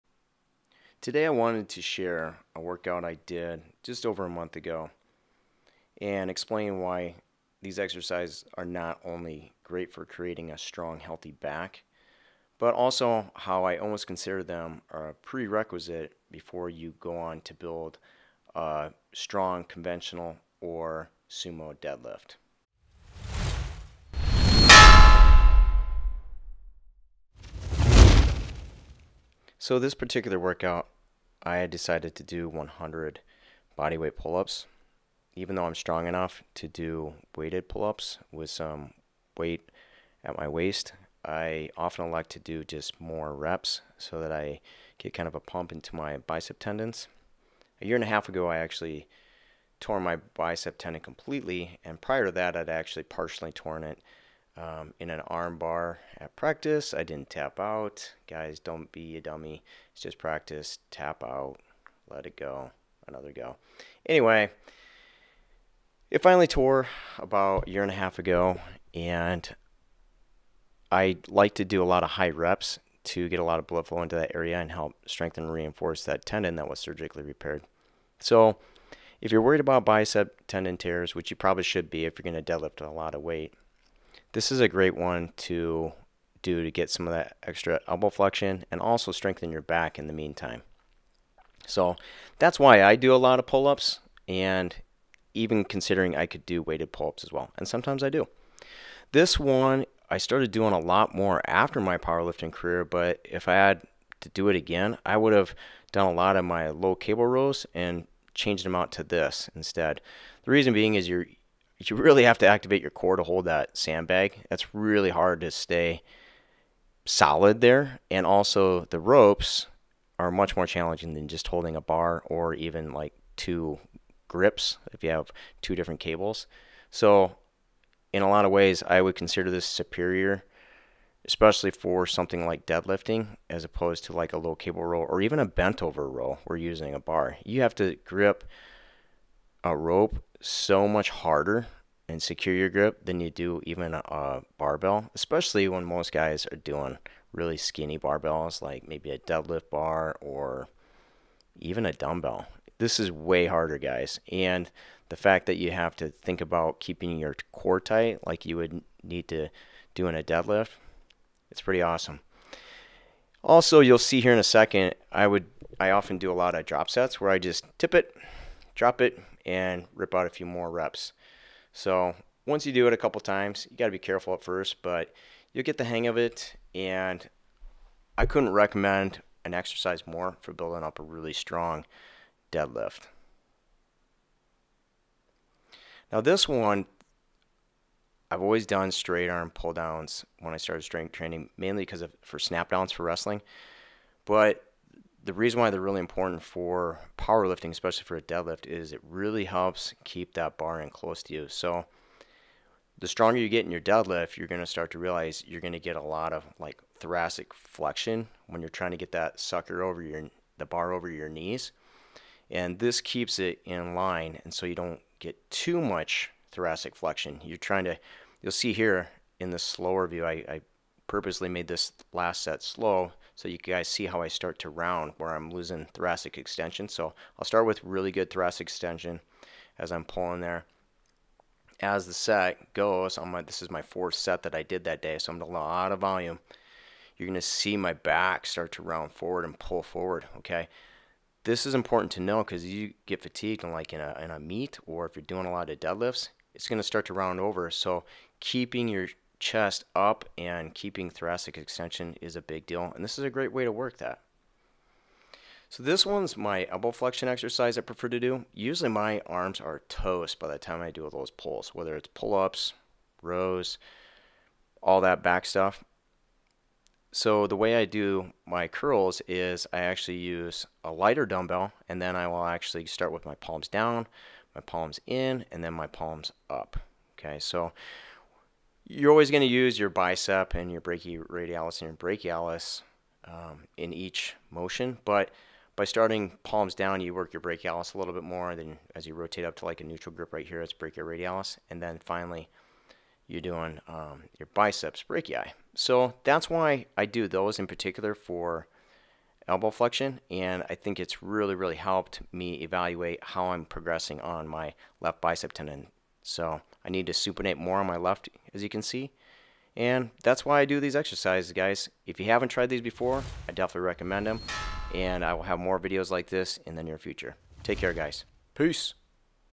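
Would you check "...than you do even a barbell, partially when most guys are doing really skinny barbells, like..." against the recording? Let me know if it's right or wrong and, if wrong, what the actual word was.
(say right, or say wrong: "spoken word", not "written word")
wrong: "especially", not "partially".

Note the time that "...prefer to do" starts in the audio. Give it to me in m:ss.
4:17.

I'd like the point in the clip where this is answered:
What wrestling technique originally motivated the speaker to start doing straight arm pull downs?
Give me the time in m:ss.
3:12.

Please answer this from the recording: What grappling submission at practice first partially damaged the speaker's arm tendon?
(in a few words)
arm bar.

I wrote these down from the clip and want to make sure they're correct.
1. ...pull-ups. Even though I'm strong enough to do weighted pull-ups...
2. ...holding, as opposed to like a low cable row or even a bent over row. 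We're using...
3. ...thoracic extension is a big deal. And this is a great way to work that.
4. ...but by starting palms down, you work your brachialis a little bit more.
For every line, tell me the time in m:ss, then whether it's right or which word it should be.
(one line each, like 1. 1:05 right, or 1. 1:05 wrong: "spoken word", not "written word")
1. 0:34 right
2. 2:12 wrong: "deadlifting", not "holding"
3. 4:11 right
4. 4:45 right.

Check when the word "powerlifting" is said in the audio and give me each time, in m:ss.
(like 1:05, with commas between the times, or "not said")
1:41, 3:17.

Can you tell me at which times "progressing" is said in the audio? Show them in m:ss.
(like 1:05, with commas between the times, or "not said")
5:03.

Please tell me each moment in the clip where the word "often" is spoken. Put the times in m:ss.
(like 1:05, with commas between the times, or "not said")
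0:41, 2:45.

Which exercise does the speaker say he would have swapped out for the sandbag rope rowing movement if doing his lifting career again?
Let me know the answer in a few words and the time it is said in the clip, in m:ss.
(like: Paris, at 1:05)
low cable rows, at 1:46.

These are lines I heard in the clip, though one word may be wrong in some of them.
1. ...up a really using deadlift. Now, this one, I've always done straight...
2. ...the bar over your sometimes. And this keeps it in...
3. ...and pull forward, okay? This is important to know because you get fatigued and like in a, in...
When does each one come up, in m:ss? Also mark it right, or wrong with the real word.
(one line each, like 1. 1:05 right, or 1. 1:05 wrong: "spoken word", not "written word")
1. 3:00 wrong: "strong", not "using"
2. 3:30 wrong: "knees", not "sometimes"
3. 3:59 right.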